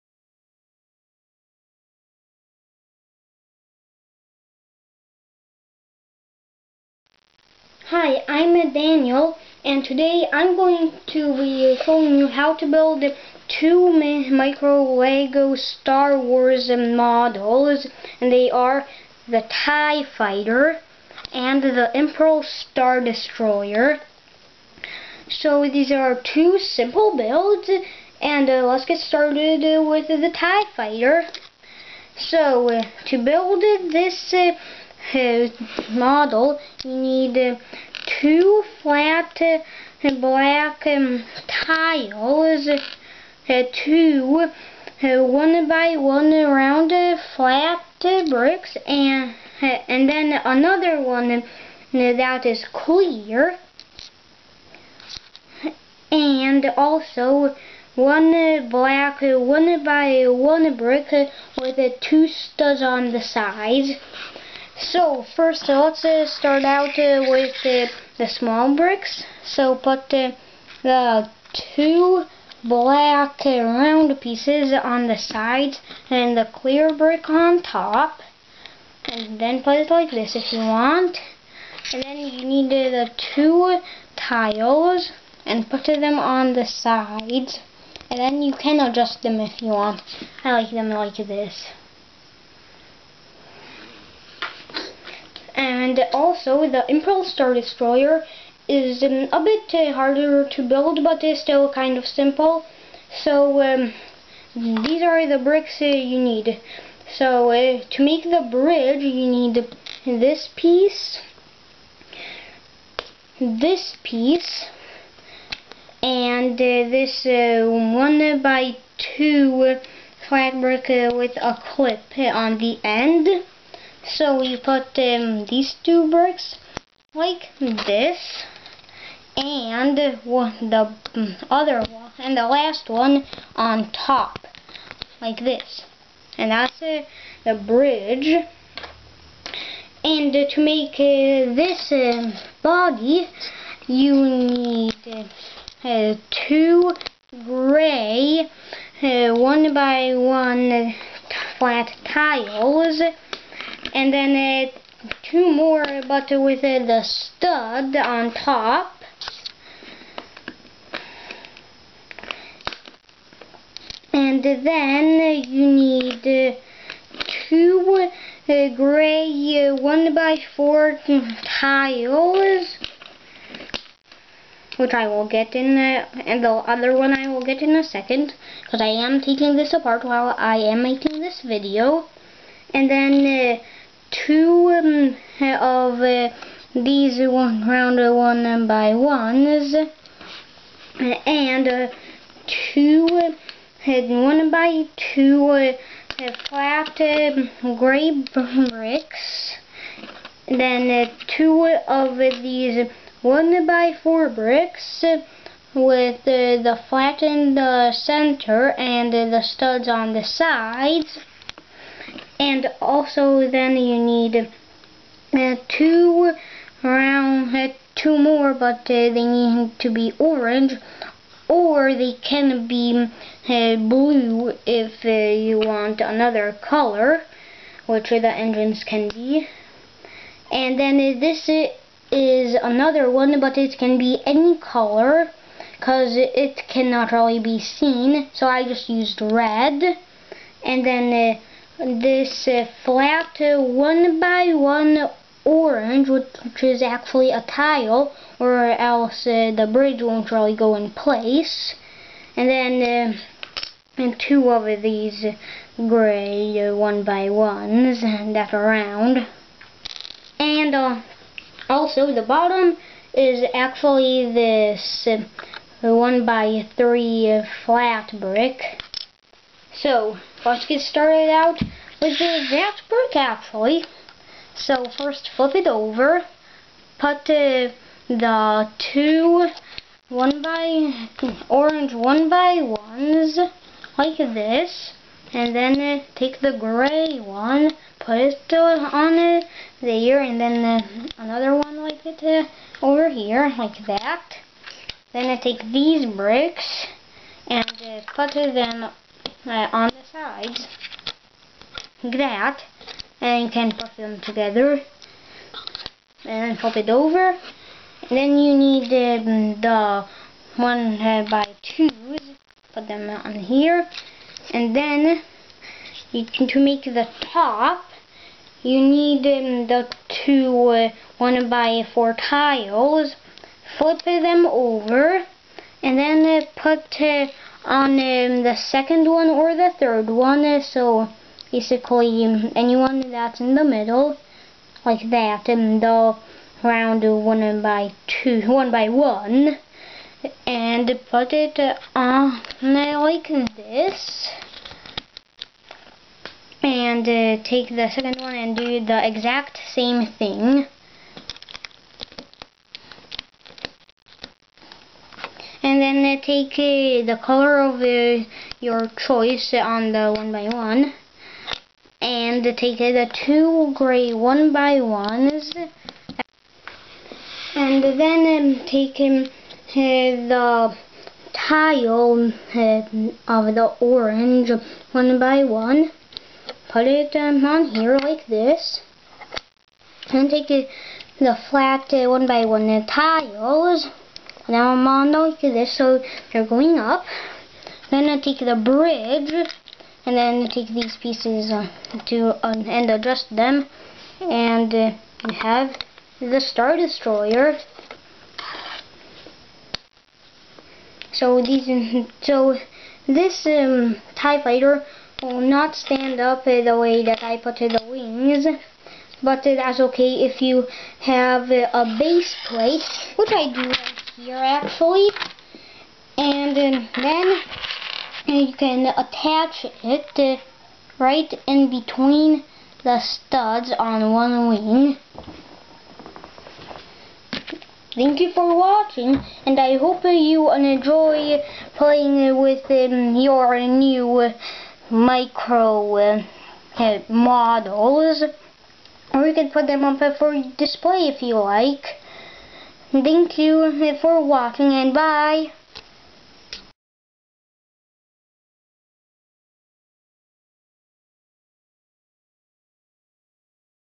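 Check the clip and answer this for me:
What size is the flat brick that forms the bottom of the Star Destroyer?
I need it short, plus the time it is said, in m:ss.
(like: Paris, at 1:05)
1 by 3, at 4:25.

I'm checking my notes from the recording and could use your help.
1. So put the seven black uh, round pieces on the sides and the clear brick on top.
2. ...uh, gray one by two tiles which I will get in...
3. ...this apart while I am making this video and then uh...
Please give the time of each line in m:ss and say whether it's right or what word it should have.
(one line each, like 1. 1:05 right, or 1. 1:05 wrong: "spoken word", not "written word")
1. 1:09 wrong: "two", not "seven"
2. 2:48 wrong: "four", not "two"
3. 2:59 right.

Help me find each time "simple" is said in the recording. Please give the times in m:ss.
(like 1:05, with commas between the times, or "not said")
0:26, 1:42.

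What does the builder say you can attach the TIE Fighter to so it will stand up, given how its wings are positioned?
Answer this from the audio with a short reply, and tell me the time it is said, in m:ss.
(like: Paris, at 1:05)
A base plate, at 6:51.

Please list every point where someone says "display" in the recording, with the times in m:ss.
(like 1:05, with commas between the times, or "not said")
7:20.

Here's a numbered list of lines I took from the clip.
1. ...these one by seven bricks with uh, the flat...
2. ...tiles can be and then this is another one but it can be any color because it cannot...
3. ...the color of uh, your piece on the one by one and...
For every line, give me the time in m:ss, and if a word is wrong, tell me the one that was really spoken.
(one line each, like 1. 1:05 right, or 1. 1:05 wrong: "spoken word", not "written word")
1. 3:22 wrong: "four", not "seven"
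2. 3:48 wrong: "engines", not "tiles"
3. 5:57 wrong: "choice", not "piece".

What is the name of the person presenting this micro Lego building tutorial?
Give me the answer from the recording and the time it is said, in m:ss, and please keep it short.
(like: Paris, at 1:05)
Daniel, at 0:08.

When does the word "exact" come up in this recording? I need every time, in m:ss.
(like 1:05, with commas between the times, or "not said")
4:32, 5:49.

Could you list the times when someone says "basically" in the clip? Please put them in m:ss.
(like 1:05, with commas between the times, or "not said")
5:31.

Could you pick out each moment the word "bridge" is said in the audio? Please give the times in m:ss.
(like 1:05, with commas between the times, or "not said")
1:48, 2:17, 4:09, 6:28.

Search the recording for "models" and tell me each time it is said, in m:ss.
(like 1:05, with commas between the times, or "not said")
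0:16, 0:35, 7:17.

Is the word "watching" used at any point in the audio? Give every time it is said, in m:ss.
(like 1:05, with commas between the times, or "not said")
7:08, 7:24.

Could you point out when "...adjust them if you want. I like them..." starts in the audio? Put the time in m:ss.
1:28.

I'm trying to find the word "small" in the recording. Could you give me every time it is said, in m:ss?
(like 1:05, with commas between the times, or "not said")
1:08.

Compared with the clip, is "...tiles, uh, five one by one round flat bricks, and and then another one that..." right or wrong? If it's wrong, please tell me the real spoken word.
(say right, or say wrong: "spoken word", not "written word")
wrong: "two", not "five".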